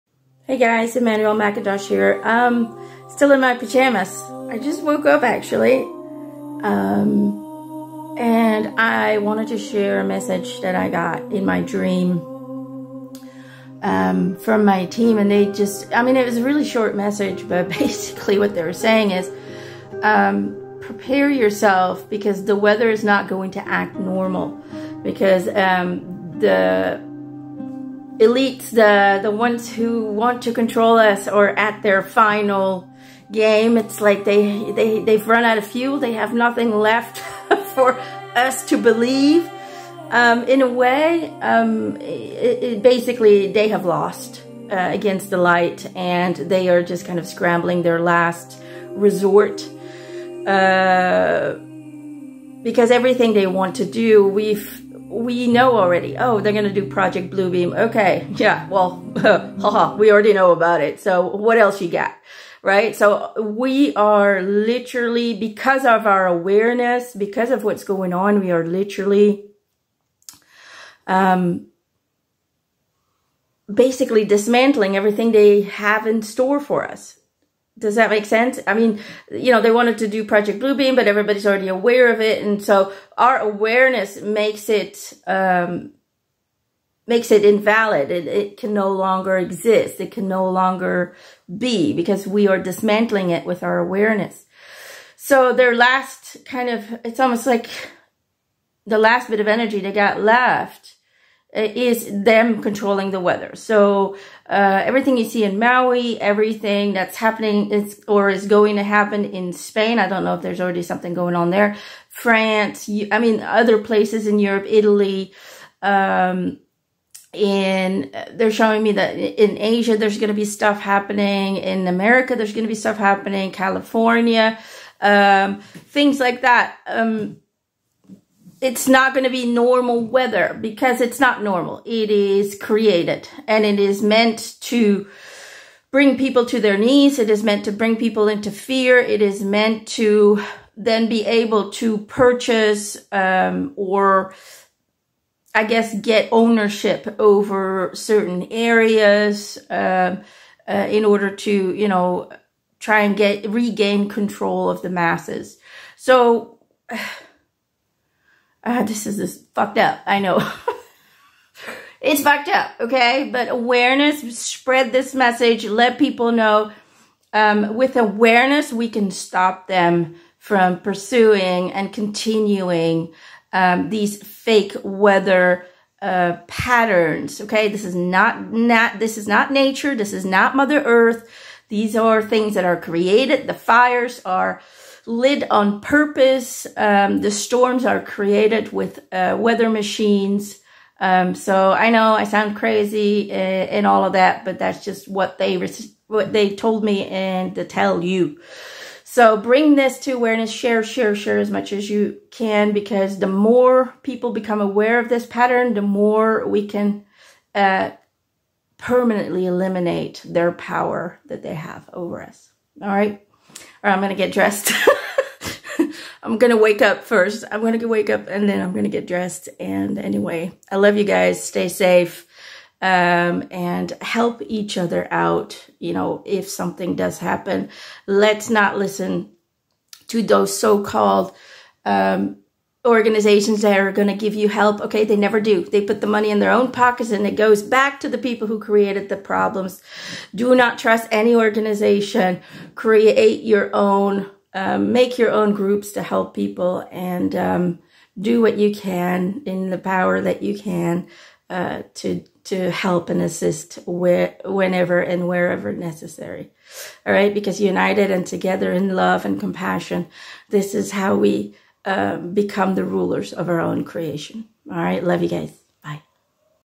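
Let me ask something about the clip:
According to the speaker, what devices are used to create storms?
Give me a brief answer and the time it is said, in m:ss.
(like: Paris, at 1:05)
weather machines, at 3:09.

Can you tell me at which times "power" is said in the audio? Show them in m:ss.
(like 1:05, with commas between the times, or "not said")
3:30, 4:09.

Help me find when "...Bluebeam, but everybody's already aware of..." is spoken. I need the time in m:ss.
1:20.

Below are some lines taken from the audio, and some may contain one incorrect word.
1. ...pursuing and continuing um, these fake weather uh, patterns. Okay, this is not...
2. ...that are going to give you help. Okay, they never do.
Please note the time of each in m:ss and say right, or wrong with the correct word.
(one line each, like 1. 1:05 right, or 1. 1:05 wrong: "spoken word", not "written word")
1. 2:50 right
2. 3:53 right.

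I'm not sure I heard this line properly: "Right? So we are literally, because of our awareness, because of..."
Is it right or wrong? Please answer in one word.
right.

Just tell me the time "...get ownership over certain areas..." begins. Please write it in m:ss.
2:25.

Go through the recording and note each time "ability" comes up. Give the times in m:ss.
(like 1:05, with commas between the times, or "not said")
not said.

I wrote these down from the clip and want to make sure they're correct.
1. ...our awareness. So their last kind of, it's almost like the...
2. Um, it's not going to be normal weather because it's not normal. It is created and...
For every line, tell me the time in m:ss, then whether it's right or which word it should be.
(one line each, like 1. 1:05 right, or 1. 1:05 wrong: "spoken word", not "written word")
1. 1:33 right
2. 2:06 right.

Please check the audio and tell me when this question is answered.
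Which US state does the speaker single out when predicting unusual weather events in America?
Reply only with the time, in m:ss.
2:03.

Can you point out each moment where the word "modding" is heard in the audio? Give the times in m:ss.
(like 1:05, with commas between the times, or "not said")
not said.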